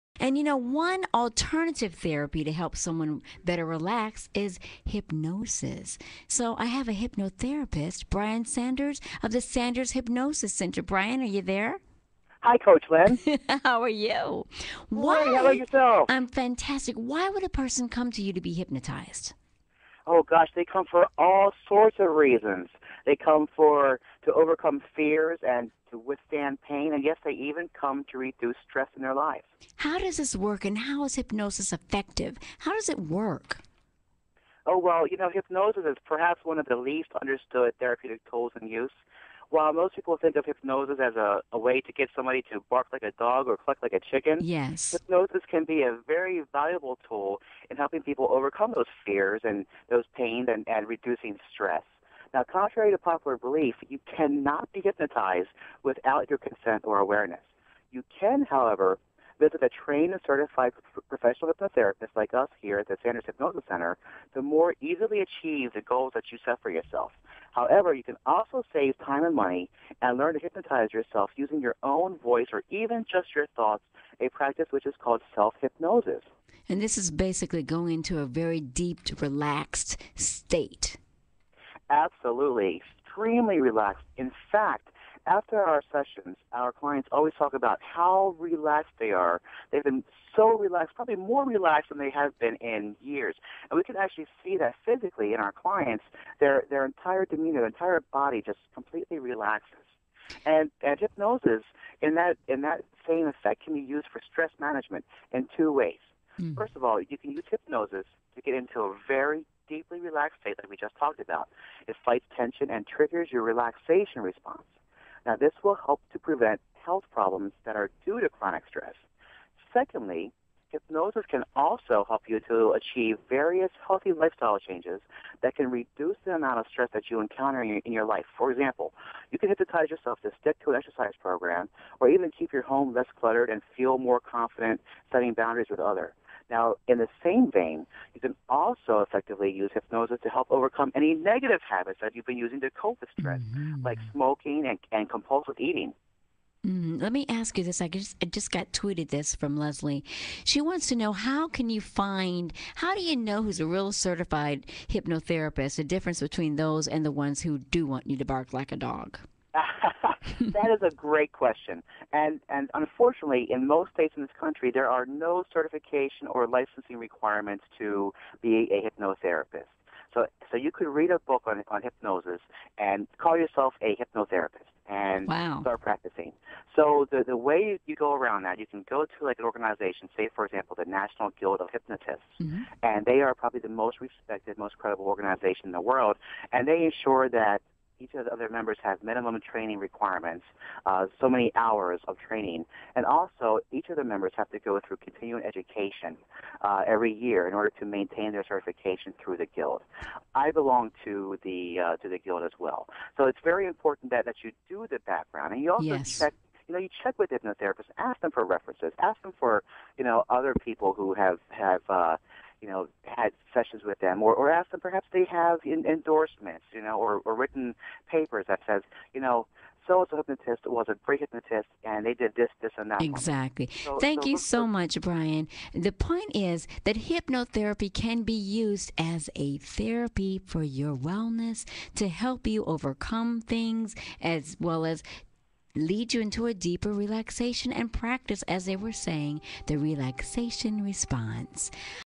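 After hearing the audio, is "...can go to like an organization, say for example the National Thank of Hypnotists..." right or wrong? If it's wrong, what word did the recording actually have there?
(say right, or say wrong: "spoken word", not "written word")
wrong: "Guild", not "Thank".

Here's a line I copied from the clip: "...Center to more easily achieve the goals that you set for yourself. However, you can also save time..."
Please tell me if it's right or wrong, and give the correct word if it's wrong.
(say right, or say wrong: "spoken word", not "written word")
right.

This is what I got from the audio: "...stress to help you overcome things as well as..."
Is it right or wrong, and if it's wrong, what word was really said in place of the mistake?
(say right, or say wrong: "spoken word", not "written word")
wrong: "wellness", not "stress".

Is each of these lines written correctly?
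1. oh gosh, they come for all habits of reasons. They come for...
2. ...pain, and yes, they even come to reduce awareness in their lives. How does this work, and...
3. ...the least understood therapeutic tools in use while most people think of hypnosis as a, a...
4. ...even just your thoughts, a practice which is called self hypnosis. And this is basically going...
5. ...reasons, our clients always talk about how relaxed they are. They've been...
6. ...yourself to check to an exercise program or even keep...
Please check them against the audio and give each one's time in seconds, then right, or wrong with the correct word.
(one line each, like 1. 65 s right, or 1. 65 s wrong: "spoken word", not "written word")
1. 20 s wrong: "sorts", not "habits"
2. 26 s wrong: "stress", not "awareness"
3. 36 s right
4. 72 s right
5. 85 s wrong: "sessions", not "reasons"
6. 129 s wrong: "stick", not "check".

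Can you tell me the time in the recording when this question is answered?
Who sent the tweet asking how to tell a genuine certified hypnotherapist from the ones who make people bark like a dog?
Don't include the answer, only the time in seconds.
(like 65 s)
149 s.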